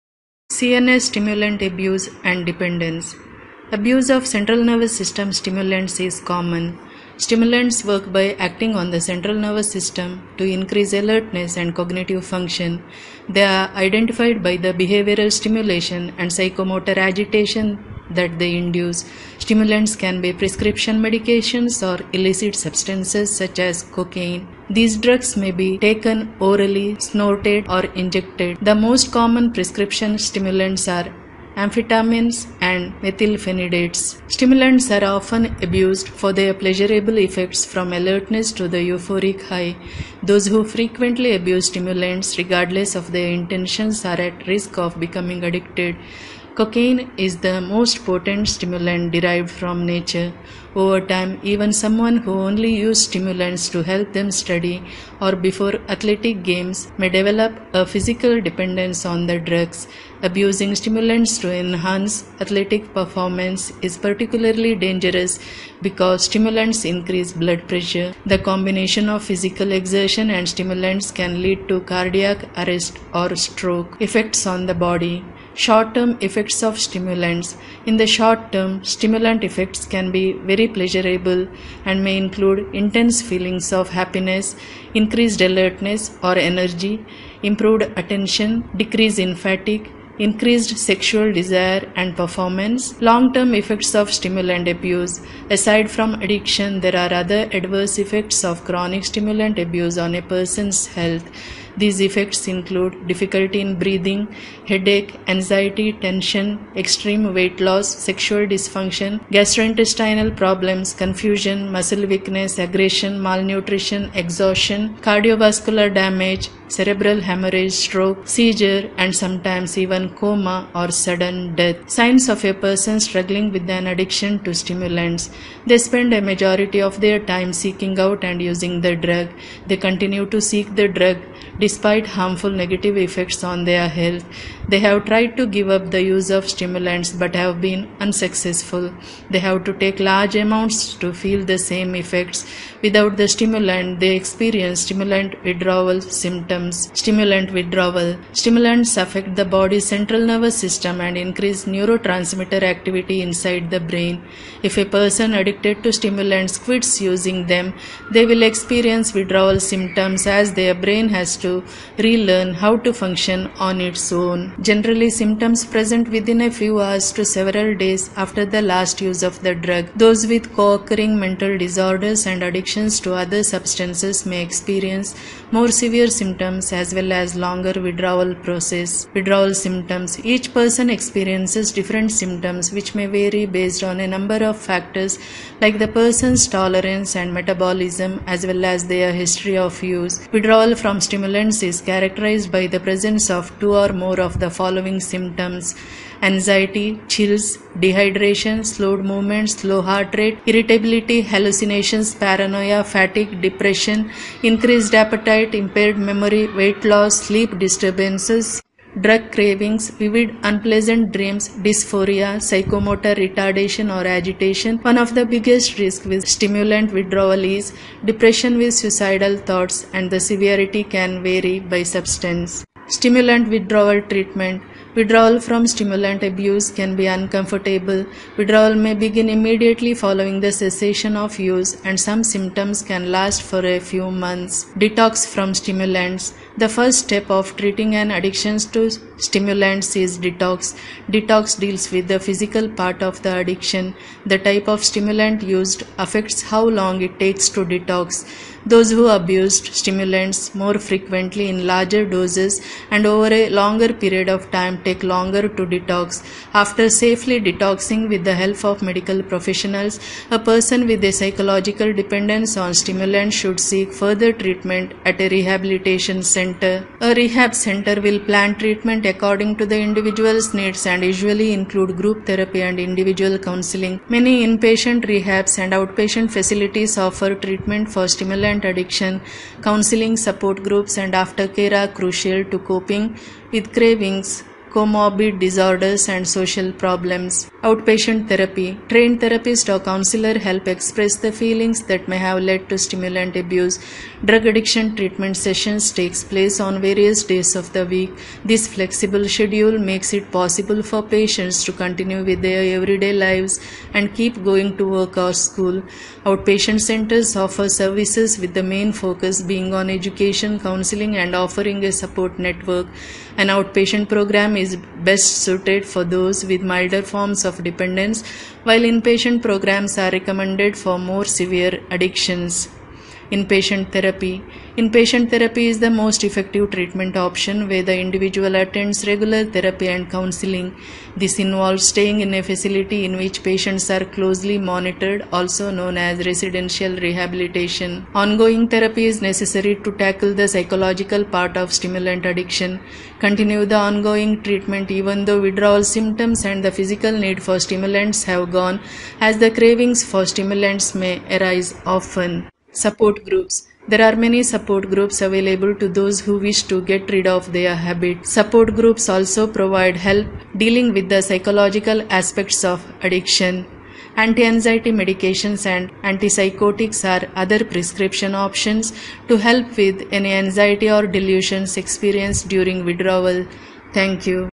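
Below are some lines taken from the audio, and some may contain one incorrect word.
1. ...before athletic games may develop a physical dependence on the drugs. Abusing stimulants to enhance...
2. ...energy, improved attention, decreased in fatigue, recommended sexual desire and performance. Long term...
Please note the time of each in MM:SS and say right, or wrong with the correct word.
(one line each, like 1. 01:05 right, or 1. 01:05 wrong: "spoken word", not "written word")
1. 00:55 right
2. 01:26 wrong: "increased", not "recommended".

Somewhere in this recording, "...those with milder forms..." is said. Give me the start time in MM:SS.
05:16.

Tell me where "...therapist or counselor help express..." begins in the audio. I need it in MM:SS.
04:49.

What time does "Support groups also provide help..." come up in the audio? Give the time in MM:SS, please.
05:58.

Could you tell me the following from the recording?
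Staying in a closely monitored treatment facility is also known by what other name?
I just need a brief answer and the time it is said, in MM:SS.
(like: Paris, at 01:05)
Residential rehabilitation, at 05:36.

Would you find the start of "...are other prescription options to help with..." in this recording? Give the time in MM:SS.
06:07.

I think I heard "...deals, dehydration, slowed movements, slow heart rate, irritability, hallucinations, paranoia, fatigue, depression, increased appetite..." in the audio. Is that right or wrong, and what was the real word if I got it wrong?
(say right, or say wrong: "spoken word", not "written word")
wrong: "chills", not "deals".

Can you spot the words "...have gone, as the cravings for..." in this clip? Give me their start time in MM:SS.
05:48.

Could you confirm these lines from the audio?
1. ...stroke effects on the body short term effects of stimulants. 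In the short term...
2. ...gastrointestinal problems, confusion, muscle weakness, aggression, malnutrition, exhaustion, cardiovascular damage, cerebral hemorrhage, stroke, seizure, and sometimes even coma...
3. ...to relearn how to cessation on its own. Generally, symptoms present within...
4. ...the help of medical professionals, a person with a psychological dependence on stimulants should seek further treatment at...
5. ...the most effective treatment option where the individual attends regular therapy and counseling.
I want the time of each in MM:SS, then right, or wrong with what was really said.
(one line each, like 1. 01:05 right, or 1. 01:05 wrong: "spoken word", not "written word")
1. 01:13 right
2. 01:49 right
3. 02:41 wrong: "function", not "cessation"
4. 04:18 right
5. 05:25 right.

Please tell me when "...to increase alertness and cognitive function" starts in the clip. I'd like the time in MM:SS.
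00:10.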